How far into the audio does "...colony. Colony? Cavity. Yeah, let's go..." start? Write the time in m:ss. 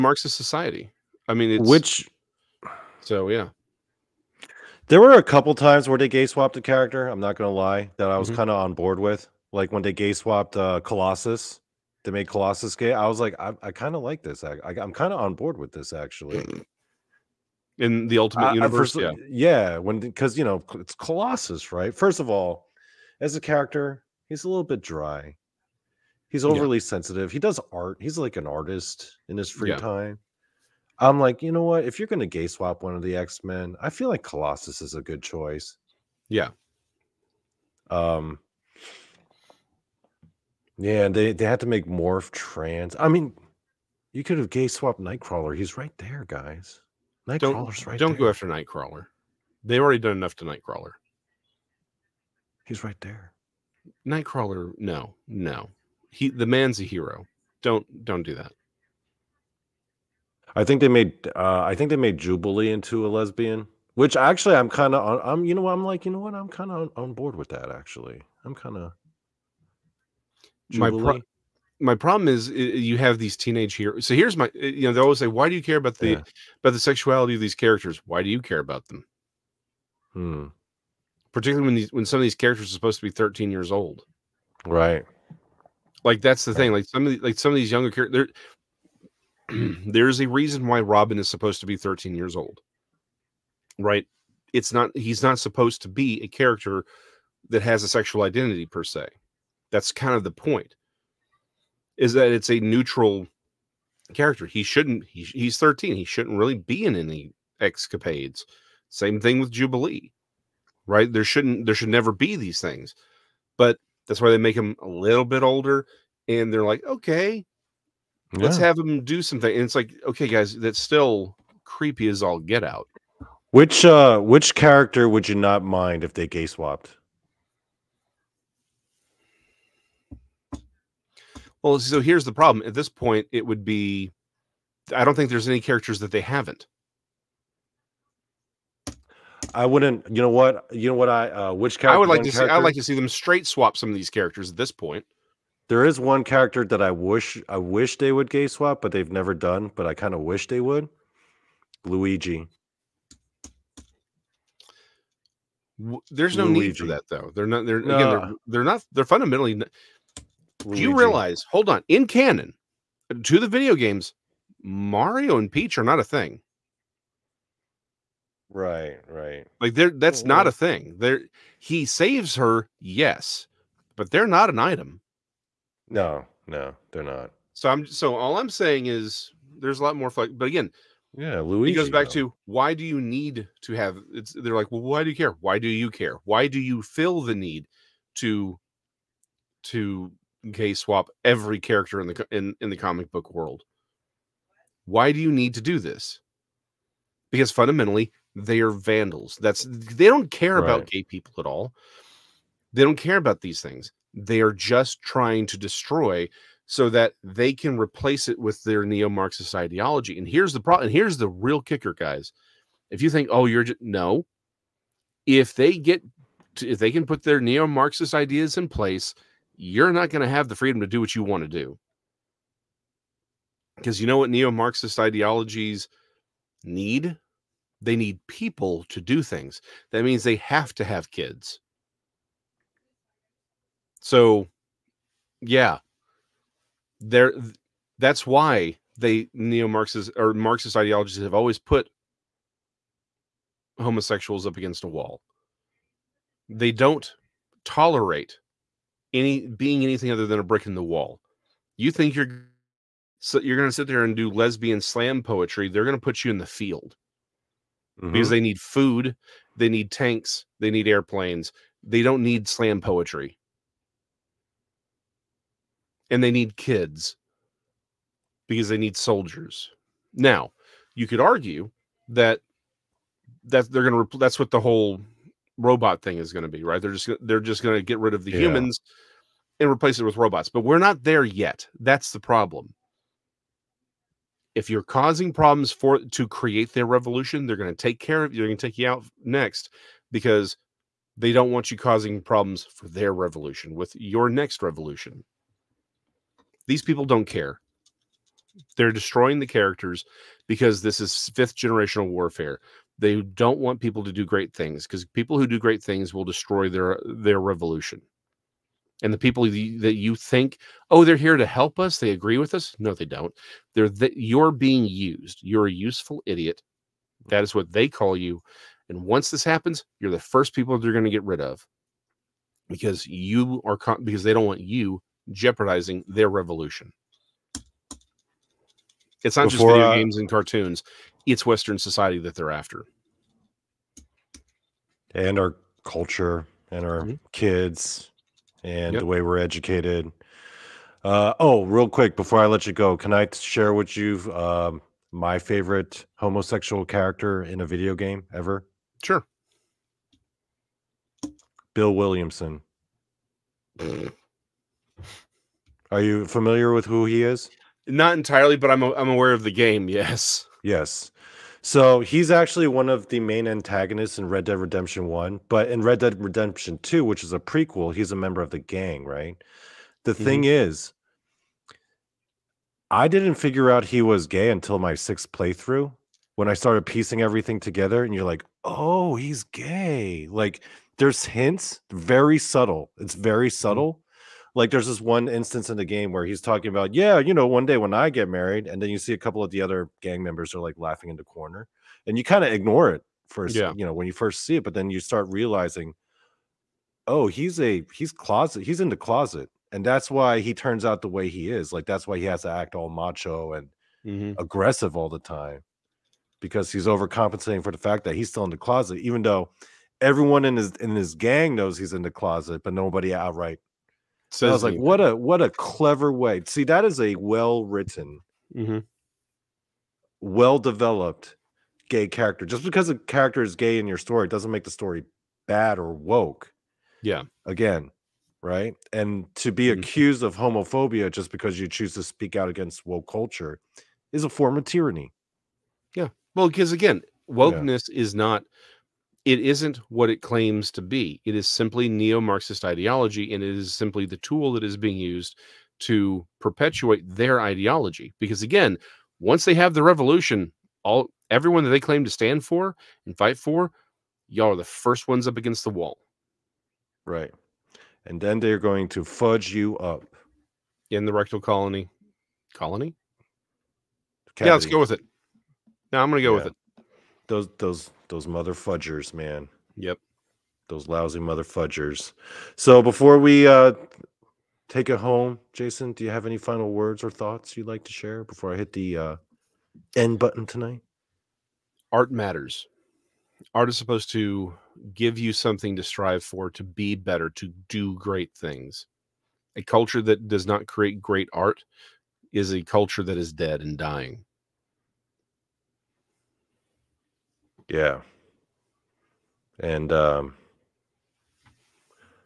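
7:41.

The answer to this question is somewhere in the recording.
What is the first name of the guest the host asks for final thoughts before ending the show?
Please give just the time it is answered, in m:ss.
7:55.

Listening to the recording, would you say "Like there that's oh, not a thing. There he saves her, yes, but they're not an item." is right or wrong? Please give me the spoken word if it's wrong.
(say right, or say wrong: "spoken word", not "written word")
right.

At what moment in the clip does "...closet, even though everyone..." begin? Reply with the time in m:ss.
6:48.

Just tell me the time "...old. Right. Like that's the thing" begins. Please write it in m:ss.
1:23.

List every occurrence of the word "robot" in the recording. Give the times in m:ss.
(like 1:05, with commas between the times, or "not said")
4:35, 4:40.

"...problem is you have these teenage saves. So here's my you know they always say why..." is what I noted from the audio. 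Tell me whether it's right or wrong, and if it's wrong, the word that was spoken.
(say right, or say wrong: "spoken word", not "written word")
wrong: "heroes", not "saves".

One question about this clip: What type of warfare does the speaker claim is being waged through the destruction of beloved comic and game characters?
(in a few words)
fifth generational warfare.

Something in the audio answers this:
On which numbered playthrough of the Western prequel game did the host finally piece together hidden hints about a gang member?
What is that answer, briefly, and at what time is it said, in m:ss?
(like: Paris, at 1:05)
sixth, at 6:14.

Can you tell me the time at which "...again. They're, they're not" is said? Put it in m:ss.
2:37.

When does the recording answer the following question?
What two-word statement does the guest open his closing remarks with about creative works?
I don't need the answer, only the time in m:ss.
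8:01.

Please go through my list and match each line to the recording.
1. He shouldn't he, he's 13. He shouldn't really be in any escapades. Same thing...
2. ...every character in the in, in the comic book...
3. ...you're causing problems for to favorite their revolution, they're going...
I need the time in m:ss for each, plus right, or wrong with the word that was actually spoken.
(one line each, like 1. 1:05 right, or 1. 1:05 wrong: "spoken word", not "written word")
1. 1:44 right
2. 3:11 right
3. 4:44 wrong: "create", not "favorite".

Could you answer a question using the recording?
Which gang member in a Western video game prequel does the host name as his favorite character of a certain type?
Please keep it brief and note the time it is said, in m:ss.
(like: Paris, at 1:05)
Bill Williamson, at 5:51.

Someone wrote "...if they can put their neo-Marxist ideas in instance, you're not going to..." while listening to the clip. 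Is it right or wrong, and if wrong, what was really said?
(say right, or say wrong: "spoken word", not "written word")
wrong: "place", not "instance".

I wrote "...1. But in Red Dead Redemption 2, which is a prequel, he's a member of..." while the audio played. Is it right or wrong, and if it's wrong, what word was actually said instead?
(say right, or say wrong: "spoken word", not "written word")
right.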